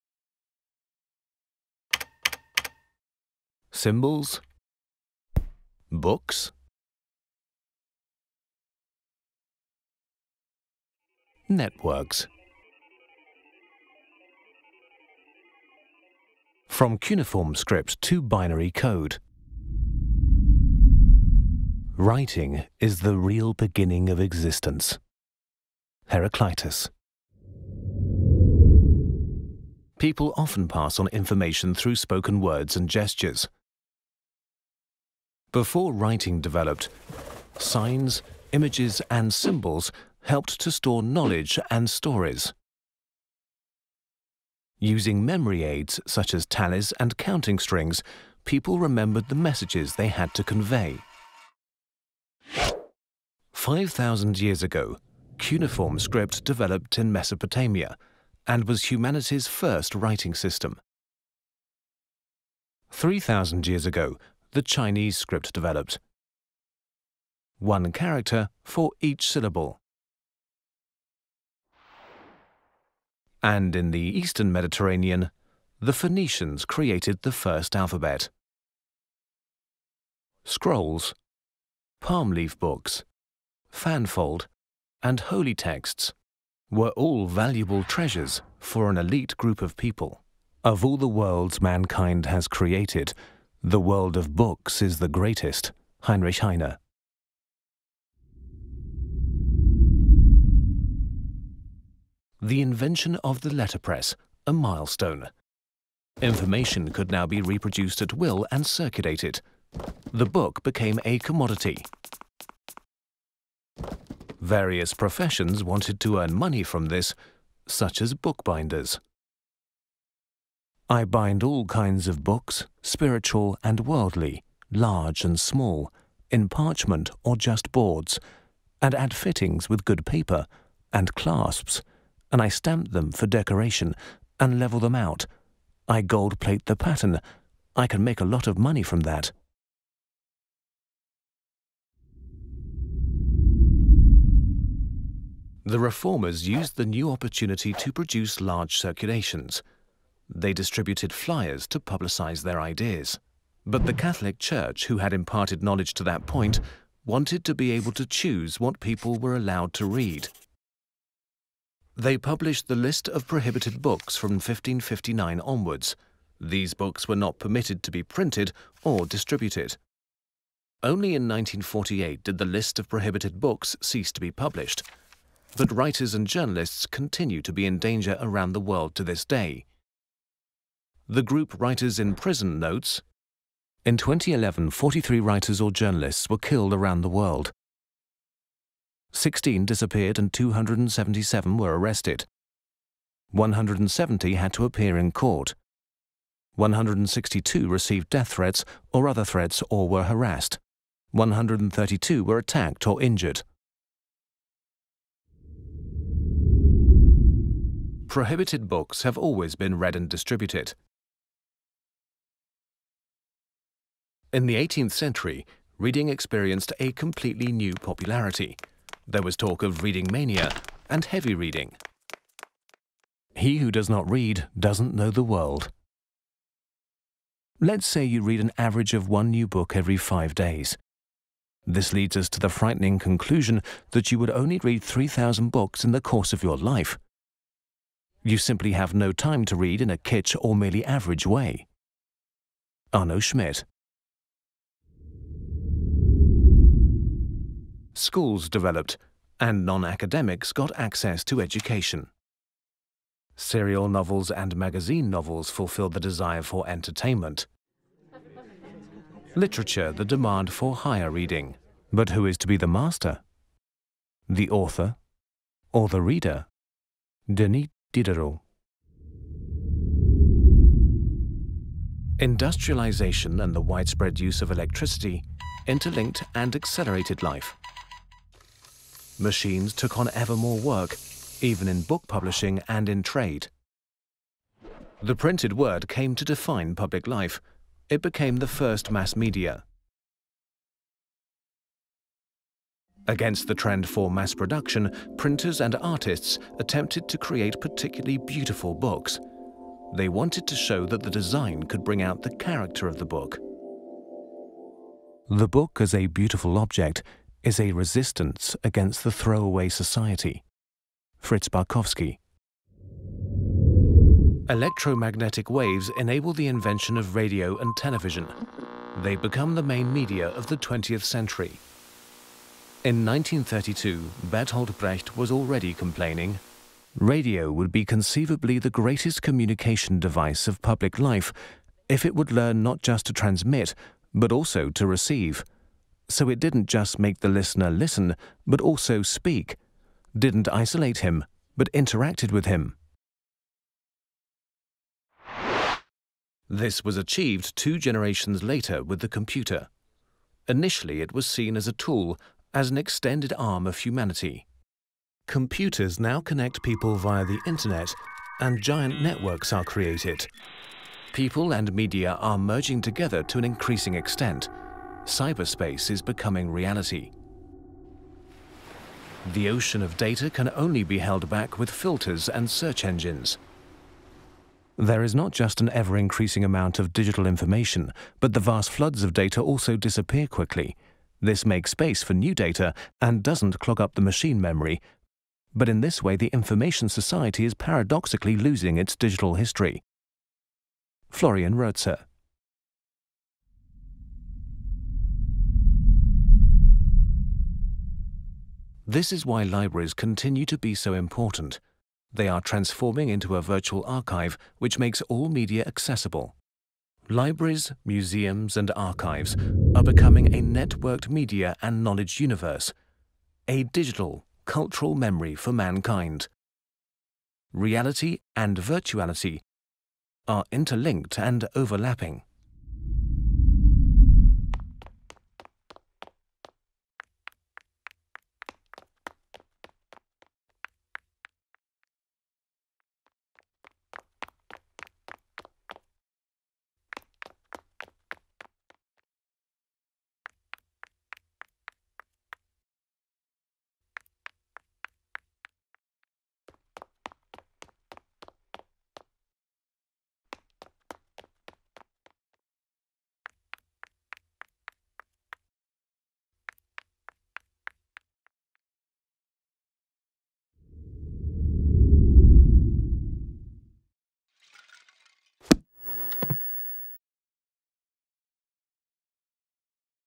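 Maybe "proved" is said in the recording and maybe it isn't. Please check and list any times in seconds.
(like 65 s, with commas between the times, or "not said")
not said.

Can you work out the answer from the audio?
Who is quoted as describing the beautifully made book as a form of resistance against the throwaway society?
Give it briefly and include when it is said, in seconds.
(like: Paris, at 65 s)
Fritz Barkowski, at 311 s.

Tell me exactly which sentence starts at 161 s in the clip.
They published the list of prohibited books from 1559 onwards.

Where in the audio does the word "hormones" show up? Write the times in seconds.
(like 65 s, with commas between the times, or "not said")
not said.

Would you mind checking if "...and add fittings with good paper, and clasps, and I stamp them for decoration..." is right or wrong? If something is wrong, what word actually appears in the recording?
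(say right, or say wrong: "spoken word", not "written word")
right.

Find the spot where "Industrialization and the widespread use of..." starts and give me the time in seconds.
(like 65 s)
272 s.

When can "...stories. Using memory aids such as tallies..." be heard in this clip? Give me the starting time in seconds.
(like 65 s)
41 s.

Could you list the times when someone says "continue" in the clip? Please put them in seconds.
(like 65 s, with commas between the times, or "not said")
176 s, 399 s.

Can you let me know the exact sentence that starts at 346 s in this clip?
This was achieved two generations later with the computer.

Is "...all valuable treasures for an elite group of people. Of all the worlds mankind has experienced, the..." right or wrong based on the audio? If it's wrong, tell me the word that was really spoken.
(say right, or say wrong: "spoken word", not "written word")
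wrong: "created", not "experienced".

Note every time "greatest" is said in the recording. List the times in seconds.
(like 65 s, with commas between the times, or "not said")
95 s, 328 s.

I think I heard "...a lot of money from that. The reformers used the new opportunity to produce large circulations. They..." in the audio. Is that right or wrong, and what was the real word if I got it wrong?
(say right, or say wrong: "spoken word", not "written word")
right.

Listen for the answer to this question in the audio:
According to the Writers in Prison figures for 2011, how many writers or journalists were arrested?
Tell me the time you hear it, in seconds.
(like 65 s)
190 s.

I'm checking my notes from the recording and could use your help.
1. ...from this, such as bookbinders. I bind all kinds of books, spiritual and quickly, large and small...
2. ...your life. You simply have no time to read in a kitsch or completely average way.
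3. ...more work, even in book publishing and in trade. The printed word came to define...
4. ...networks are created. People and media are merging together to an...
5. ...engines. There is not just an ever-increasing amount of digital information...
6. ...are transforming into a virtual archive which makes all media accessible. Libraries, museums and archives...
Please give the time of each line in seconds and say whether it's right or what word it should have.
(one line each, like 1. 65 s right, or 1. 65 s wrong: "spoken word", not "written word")
1. 116 s wrong: "worldly", not "quickly"
2. 236 s wrong: "merely", not "completely"
3. 280 s right
4. 359 s right
5. 372 s right
6. 402 s right.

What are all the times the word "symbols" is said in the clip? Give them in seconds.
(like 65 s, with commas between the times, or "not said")
3 s, 39 s.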